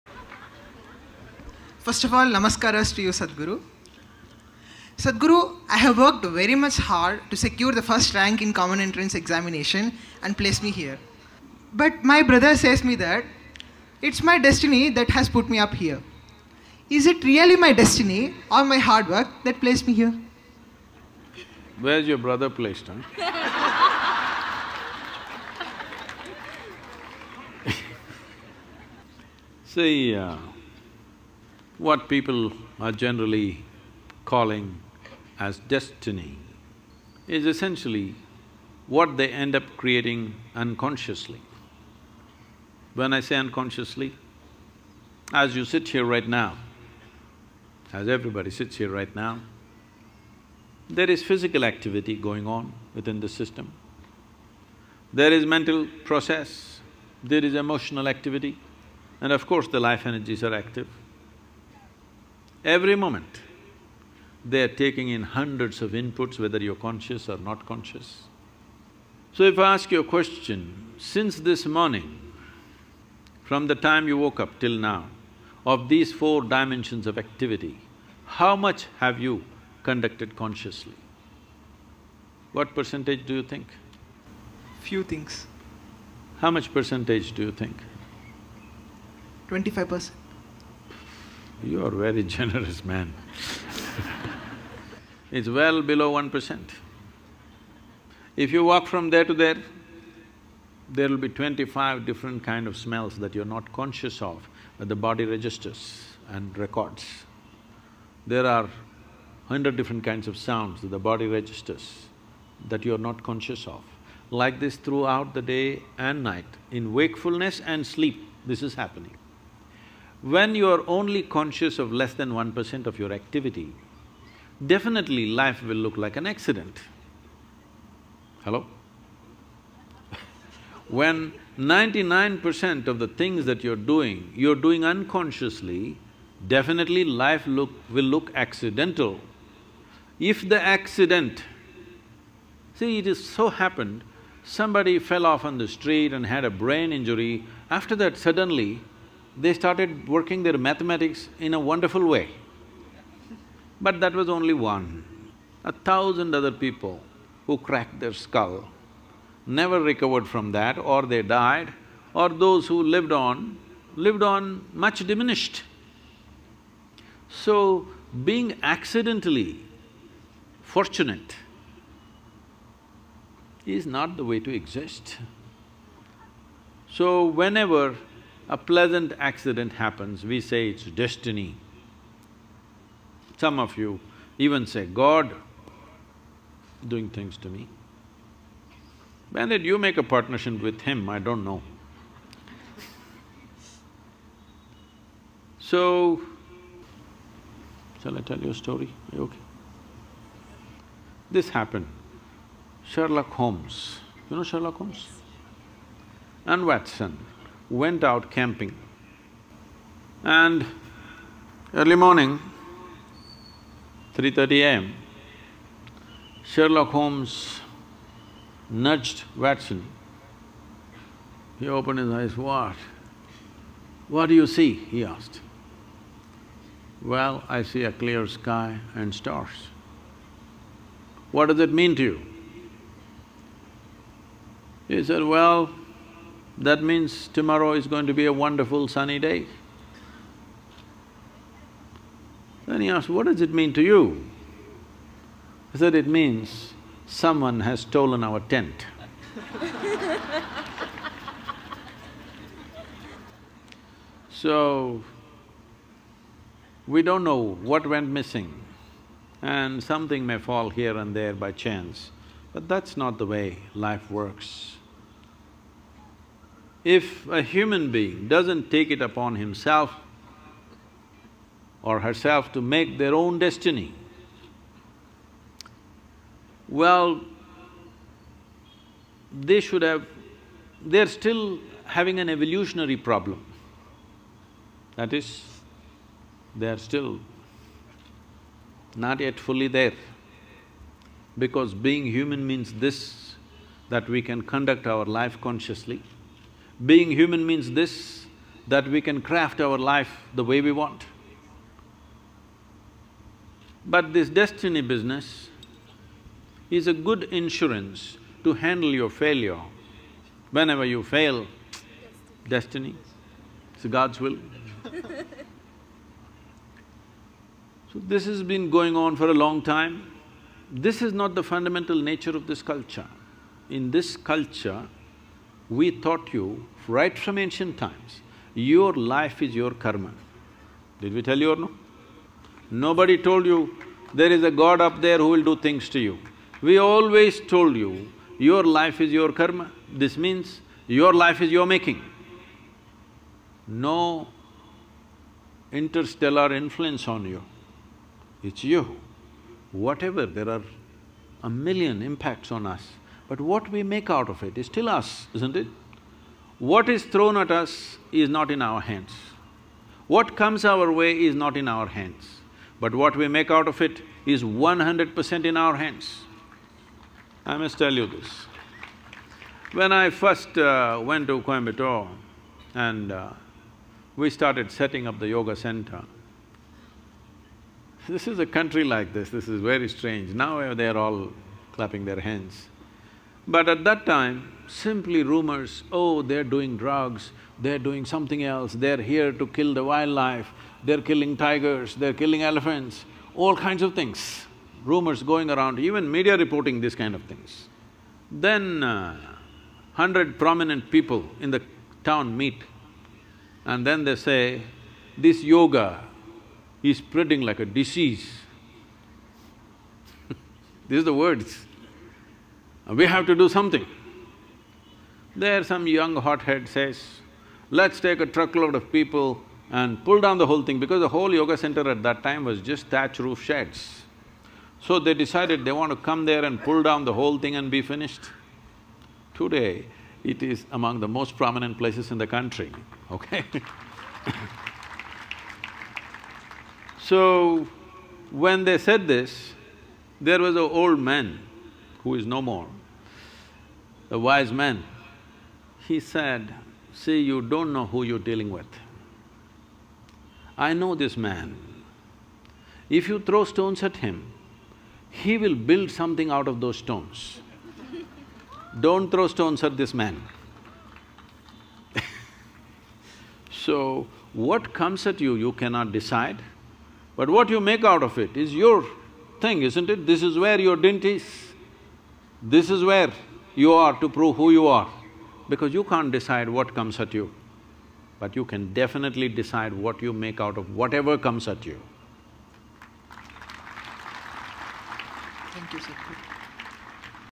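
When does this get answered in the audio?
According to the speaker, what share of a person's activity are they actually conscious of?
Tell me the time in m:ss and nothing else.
1:35.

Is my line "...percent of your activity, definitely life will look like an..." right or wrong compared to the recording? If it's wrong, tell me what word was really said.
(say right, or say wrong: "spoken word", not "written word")
right.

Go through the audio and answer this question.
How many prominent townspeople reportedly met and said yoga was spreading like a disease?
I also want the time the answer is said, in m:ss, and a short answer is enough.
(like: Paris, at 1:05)
100, at 6:39.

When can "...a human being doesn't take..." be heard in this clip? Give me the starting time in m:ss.
4:27.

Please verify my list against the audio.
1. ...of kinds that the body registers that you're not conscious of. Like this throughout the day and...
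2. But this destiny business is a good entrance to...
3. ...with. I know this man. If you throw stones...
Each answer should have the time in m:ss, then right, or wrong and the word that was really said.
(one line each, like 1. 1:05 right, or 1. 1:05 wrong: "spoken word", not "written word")
1. 1:50 wrong: "sounds", not "kinds"
2. 5:03 wrong: "insurance", not "entrance"
3. 7:28 right.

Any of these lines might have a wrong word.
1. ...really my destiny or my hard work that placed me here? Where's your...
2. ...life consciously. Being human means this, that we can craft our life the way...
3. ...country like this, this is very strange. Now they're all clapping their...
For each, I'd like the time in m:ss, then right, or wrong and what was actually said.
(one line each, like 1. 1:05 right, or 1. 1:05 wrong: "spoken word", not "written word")
1. 0:17 right
2. 4:55 right
3. 6:18 right.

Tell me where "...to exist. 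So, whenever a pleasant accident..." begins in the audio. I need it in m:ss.
2:54.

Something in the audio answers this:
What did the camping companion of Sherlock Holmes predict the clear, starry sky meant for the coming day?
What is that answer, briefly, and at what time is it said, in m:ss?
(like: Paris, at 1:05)
A wonderful sunny day, at 3:58.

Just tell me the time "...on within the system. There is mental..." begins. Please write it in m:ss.
0:52.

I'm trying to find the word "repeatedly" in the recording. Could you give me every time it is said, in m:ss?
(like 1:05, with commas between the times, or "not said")
not said.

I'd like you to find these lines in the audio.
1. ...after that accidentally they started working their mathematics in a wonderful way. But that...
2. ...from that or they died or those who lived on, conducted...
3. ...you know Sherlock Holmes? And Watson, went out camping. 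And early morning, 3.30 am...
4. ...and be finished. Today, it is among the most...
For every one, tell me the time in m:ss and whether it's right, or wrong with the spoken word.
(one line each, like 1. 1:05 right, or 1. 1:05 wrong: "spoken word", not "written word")
1. 2:27 wrong: "suddenly", not "accidentally"
2. 2:40 wrong: "lived", not "conducted"
3. 3:24 right
4. 7:07 right.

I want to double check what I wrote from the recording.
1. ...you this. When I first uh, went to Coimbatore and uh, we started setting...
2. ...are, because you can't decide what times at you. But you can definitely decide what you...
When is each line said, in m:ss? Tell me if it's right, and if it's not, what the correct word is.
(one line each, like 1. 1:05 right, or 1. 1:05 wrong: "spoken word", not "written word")
1. 6:08 right
2. 7:54 wrong: "comes", not "times".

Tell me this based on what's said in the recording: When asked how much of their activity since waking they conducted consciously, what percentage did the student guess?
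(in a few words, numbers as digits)
25 percent.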